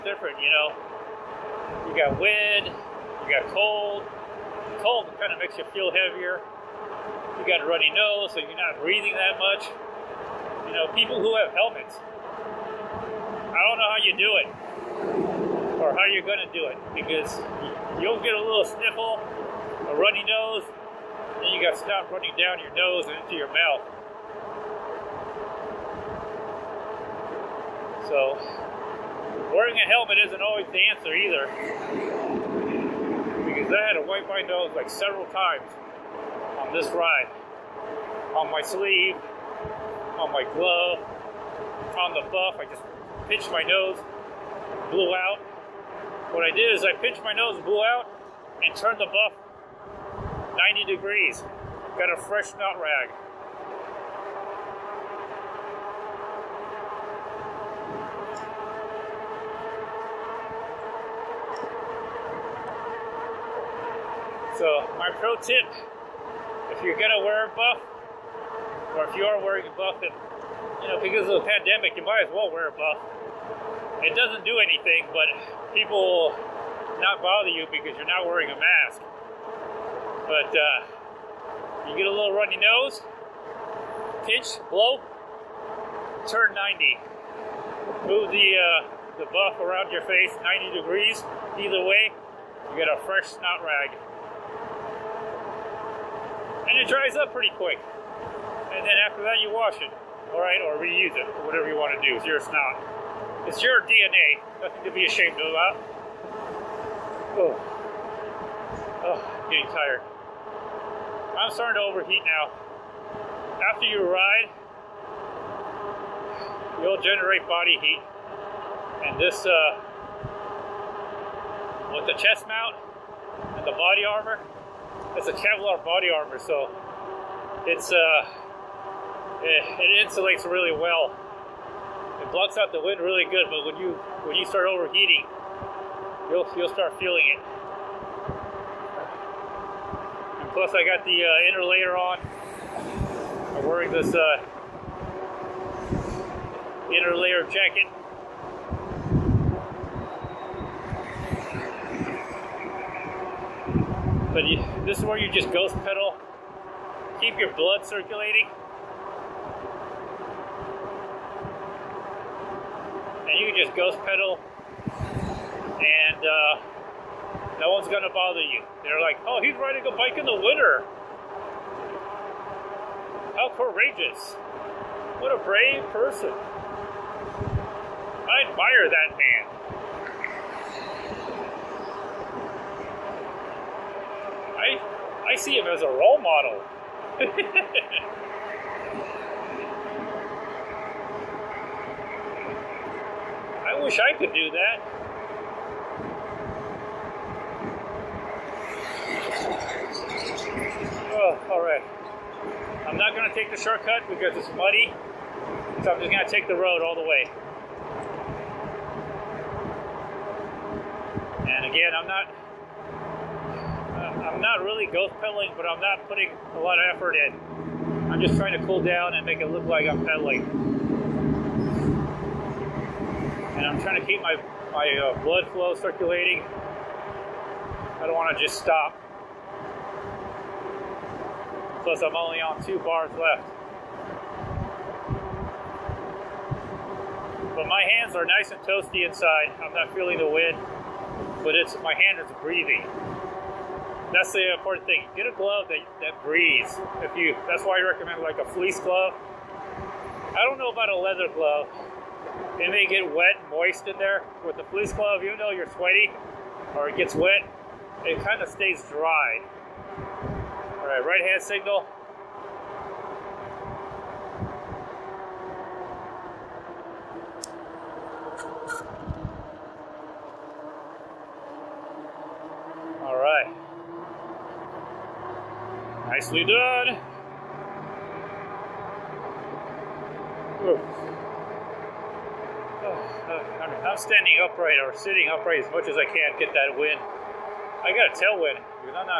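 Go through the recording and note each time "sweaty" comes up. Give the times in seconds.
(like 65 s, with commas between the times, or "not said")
255 s.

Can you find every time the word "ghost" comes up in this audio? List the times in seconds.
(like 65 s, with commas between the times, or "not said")
155 s, 163 s, 214 s.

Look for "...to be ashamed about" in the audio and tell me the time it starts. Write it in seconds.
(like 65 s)
104 s.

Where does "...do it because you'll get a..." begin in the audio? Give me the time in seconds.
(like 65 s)
16 s.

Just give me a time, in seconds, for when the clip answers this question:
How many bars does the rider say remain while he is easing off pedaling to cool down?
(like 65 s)
232 s.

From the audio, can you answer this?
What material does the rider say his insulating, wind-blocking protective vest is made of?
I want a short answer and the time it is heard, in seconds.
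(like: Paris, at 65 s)
Kevlar, at 125 s.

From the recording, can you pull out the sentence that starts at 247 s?
If you, that's why I recommend like a fleece glove.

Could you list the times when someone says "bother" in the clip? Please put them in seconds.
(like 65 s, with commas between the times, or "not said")
77 s, 168 s.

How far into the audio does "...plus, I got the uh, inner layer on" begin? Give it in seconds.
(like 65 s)
140 s.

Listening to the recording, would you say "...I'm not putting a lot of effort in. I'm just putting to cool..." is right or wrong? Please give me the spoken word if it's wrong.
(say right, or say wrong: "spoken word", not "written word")
wrong: "trying", not "putting".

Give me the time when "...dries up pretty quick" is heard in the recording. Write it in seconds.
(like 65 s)
96 s.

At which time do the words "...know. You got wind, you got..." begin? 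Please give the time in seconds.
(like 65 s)
0 s.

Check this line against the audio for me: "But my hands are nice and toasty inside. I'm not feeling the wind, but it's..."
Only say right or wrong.
right.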